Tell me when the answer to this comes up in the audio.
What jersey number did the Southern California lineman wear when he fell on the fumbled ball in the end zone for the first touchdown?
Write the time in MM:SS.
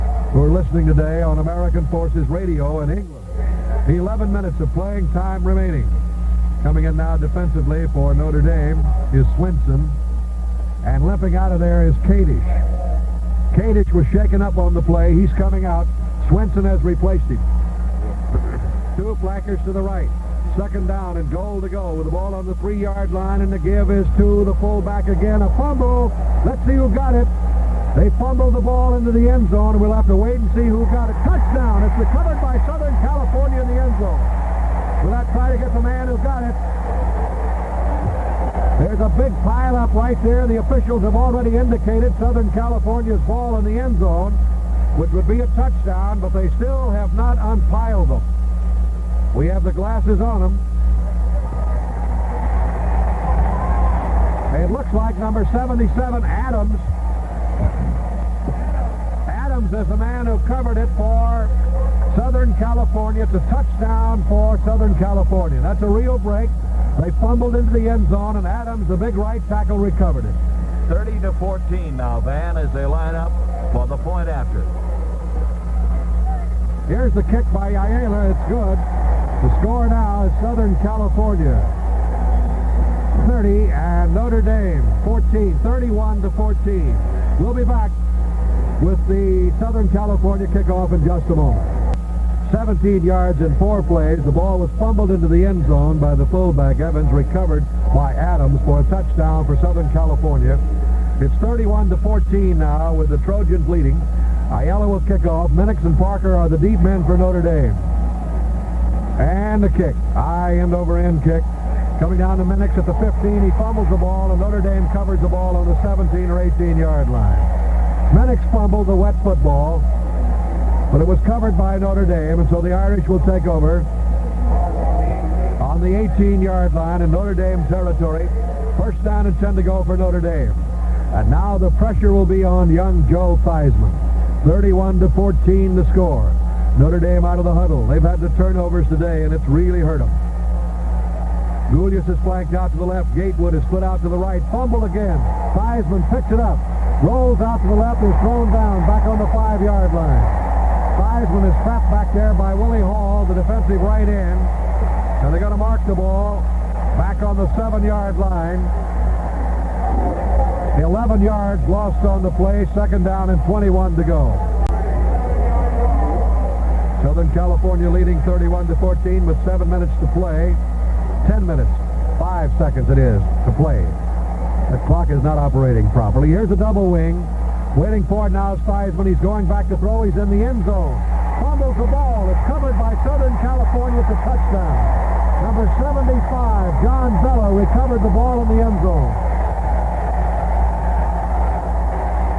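00:55.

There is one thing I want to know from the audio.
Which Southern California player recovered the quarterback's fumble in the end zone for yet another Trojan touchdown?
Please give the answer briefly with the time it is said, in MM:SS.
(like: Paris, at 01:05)
John Vella, at 03:06.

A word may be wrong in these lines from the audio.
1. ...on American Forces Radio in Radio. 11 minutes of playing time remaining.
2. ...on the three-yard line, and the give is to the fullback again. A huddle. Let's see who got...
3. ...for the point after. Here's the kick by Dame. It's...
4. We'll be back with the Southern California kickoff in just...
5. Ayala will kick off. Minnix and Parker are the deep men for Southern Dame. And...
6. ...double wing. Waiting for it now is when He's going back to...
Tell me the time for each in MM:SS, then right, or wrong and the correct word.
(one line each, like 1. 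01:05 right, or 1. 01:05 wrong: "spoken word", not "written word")
1. 00:01 wrong: "England", not "Radio"
2. 00:22 wrong: "fumble", not "huddle"
3. 01:13 wrong: "Ayala", not "Dame"
4. 01:27 right
5. 01:44 wrong: "Notre", not "Southern"
6. 02:56 right.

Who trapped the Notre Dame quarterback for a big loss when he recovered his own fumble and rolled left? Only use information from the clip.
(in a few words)
Willie Hall.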